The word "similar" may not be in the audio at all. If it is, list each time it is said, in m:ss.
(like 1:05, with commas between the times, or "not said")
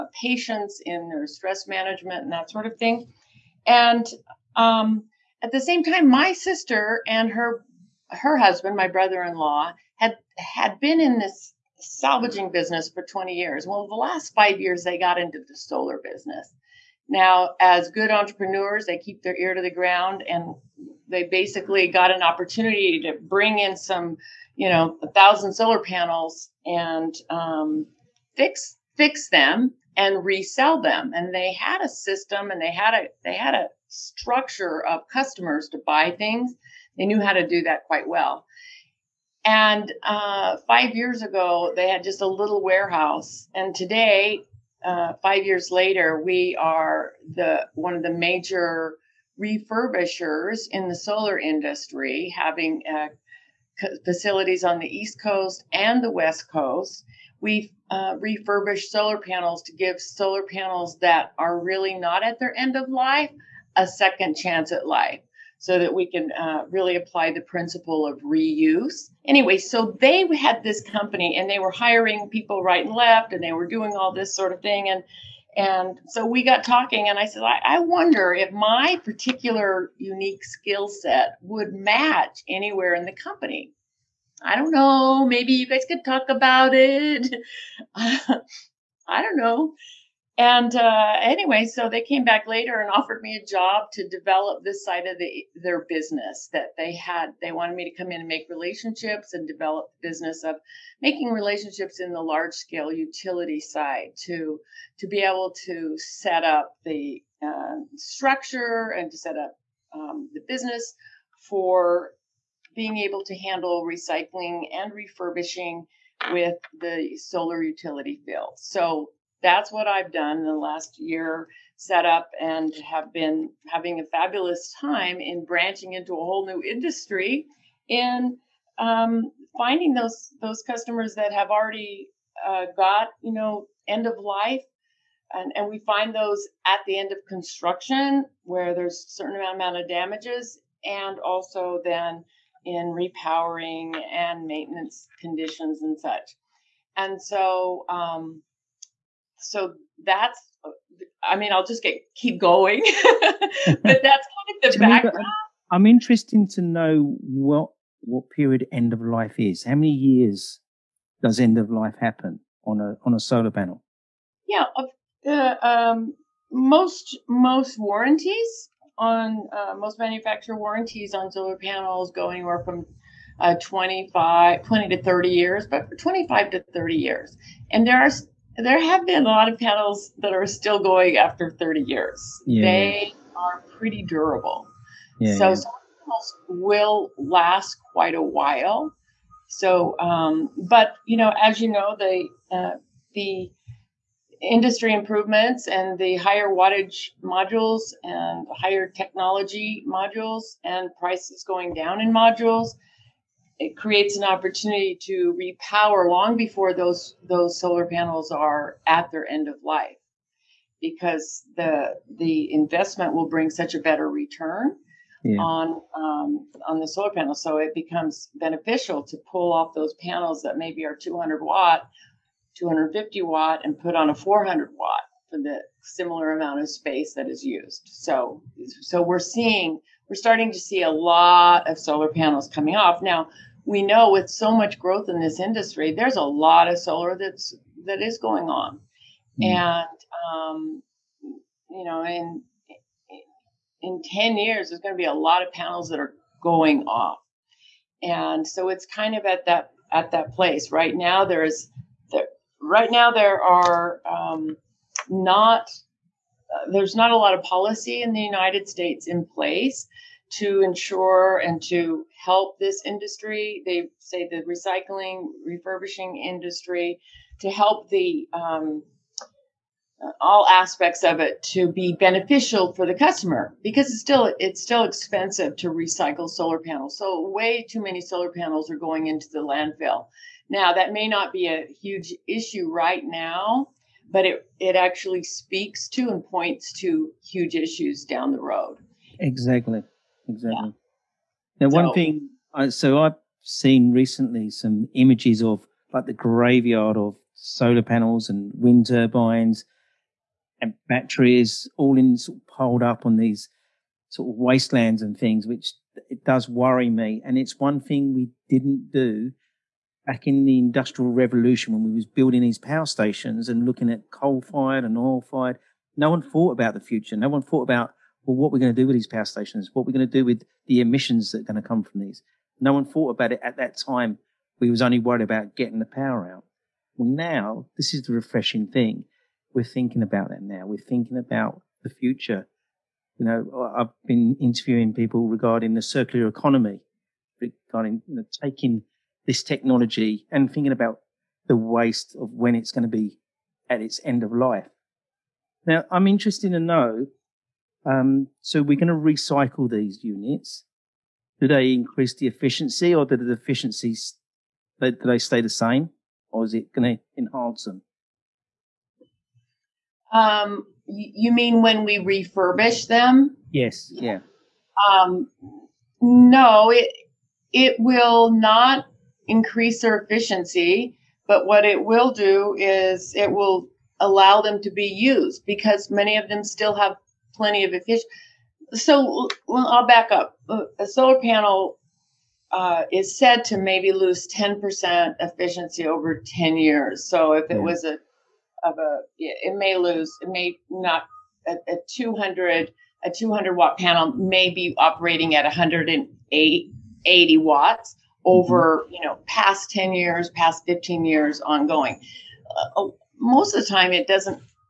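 3:45.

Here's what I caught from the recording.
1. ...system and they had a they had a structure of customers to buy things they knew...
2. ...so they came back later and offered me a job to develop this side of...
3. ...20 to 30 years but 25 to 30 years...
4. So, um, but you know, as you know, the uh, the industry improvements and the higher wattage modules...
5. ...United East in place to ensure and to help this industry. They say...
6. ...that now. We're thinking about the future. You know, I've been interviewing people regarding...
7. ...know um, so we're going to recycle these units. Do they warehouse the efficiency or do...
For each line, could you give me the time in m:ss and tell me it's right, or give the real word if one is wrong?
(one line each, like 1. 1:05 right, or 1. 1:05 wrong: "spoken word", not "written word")
1. 0:31 right
2. 1:31 right
3. 2:54 right
4. 3:09 right
5. 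4:18 wrong: "States", not "East"
6. 5:30 right
7. 5:46 wrong: "increase", not "warehouse".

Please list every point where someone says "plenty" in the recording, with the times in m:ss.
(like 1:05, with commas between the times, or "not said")
6:17.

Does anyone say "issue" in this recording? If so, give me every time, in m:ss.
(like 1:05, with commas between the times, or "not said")
4:42, 4:47.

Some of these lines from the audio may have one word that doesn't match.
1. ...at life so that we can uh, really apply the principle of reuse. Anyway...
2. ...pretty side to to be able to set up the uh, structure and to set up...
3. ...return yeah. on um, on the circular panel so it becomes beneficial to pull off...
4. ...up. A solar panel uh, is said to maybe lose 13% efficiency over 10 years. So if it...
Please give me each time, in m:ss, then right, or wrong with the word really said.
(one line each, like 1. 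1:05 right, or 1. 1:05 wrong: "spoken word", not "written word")
1. 1:04 right
2. 1:42 wrong: "utility", not "pretty"
3. 3:34 wrong: "solar", not "circular"
4. 6:20 wrong: "10", not "13".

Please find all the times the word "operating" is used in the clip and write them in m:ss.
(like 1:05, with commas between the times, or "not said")
6:34.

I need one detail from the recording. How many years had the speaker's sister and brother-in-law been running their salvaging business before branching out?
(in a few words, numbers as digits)
20.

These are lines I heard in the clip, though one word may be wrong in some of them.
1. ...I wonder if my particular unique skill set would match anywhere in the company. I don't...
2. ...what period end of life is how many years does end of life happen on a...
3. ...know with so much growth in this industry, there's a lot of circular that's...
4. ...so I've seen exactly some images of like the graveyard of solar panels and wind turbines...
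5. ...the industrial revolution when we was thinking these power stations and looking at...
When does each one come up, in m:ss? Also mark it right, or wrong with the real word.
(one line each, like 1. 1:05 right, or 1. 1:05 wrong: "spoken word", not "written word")
1. 1:17 right
2. 2:38 right
3. 3:53 wrong: "solar", not "circular"
4. 4:52 wrong: "recently", not "exactly"
5. 5:10 wrong: "building", not "thinking".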